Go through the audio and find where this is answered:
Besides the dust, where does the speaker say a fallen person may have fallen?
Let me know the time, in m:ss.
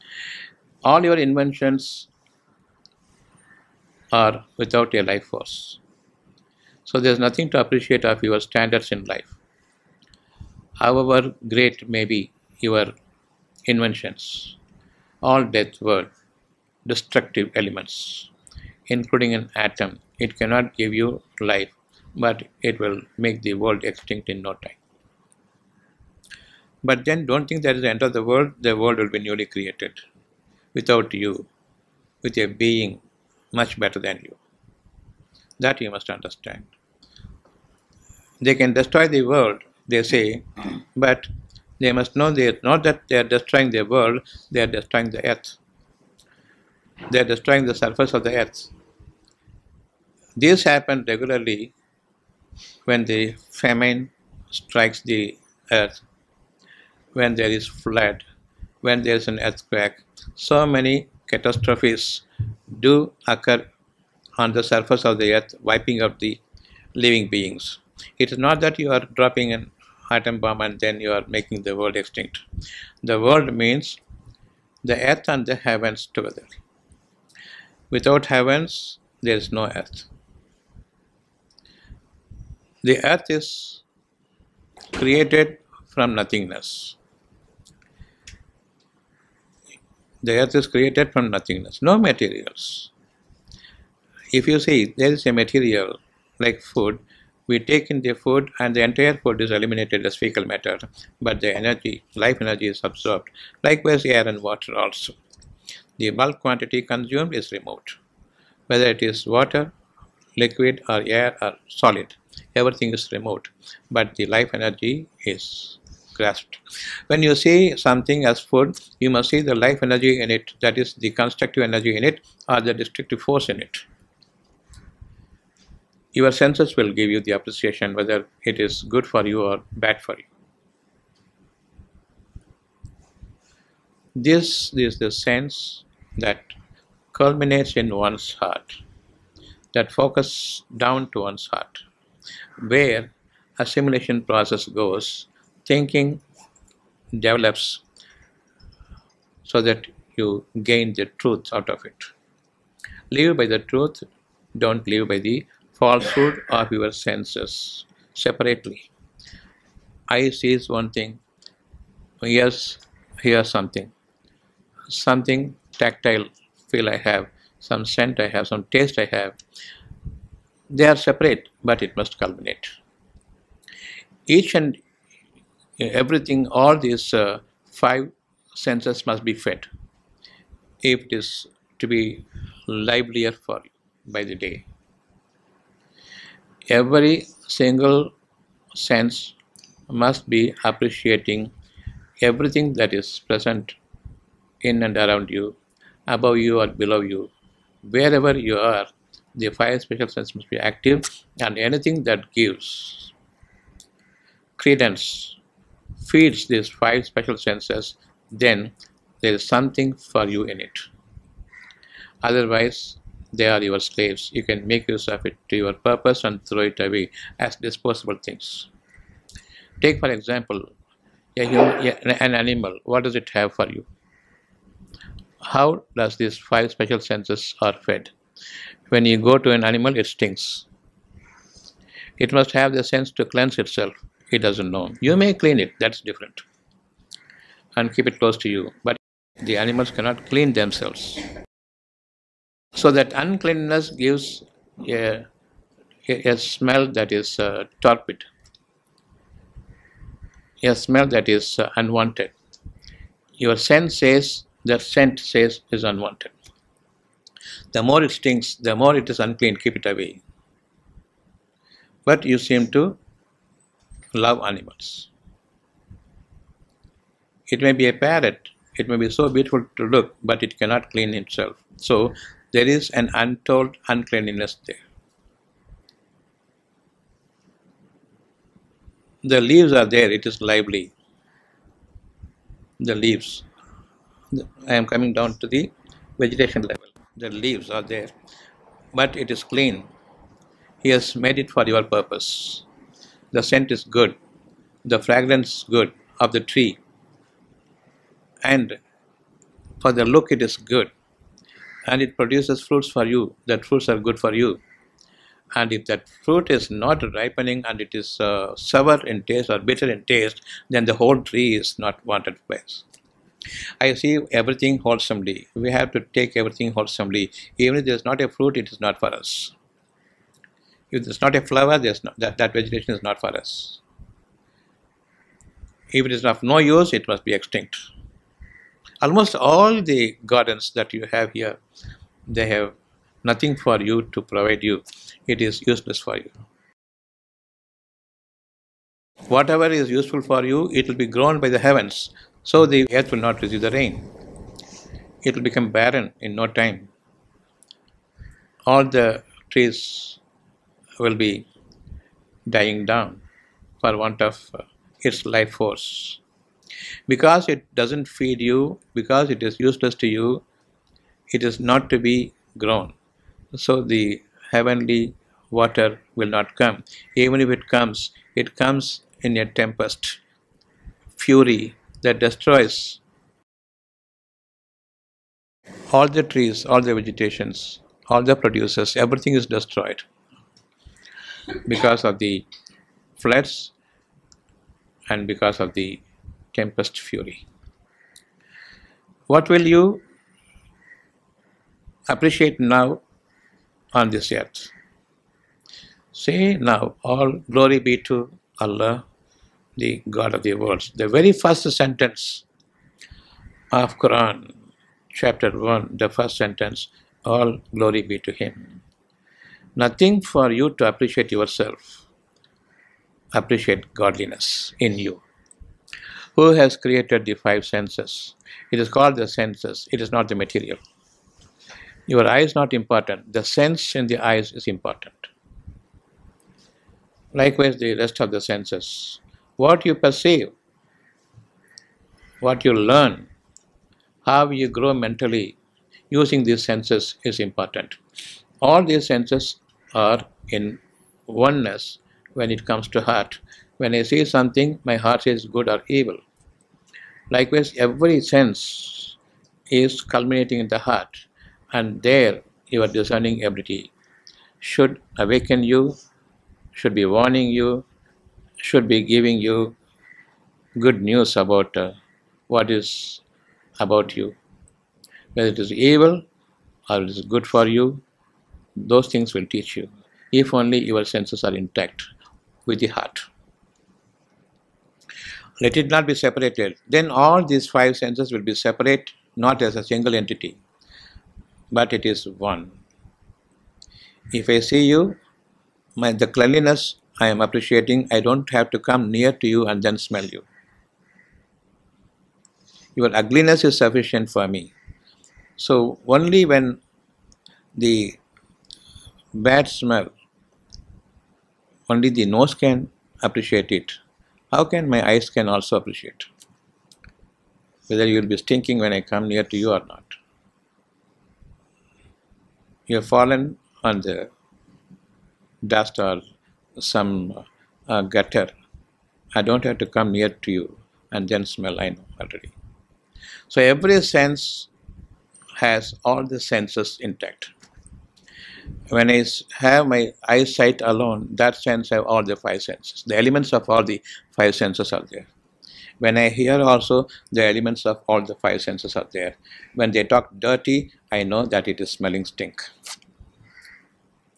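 8:38.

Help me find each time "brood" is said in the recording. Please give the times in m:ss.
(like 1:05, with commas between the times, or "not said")
not said.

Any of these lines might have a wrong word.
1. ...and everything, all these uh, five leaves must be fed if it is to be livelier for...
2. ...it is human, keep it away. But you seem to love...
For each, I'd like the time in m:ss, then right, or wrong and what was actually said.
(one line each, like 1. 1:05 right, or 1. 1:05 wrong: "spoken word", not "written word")
1. 2:54 wrong: "senses", not "leaves"
2. 4:18 wrong: "unclean", not "human".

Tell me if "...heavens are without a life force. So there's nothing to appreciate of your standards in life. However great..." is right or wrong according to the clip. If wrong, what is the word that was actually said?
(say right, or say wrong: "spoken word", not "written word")
wrong: "inventions", not "heavens".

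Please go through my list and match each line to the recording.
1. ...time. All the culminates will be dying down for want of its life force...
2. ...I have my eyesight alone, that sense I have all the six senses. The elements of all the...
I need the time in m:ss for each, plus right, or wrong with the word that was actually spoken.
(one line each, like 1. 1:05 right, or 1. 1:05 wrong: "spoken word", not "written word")
1. 5:46 wrong: "trees", not "culminates"
2. 8:49 wrong: "five", not "six".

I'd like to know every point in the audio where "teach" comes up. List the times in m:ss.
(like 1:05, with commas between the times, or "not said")
7:49.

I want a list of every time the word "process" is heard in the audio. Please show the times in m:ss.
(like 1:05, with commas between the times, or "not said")
2:24.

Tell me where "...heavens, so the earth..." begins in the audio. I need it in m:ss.
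5:41.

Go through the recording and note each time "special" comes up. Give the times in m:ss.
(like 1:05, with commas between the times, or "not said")
3:19, 3:27, 3:46.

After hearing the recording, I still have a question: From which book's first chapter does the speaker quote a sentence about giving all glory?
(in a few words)
Quran.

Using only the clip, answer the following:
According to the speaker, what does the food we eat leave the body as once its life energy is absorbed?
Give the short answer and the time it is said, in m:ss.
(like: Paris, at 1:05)
fecal matter, at 1:40.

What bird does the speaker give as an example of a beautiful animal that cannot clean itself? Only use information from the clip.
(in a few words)
parrot.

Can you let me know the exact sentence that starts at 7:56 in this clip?
Then all these five senses will be separate, not as a single entity, but it is one.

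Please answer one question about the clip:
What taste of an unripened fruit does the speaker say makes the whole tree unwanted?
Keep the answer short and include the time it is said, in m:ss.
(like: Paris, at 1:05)
sour, at 5:08.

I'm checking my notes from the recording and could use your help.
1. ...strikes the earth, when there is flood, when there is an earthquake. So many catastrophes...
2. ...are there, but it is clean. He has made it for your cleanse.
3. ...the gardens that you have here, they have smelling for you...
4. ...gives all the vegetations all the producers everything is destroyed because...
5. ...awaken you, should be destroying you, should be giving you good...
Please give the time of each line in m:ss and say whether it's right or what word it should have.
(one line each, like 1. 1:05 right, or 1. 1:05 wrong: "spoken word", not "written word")
1. 0:54 right
2. 4:47 wrong: "purpose", not "cleanse"
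3. 5:29 wrong: "nothing", not "smelling"
4. 6:16 wrong: "trees", not "gives"
5. 7:35 wrong: "warning", not "destroying".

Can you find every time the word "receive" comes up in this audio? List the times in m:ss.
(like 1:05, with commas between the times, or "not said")
5:43.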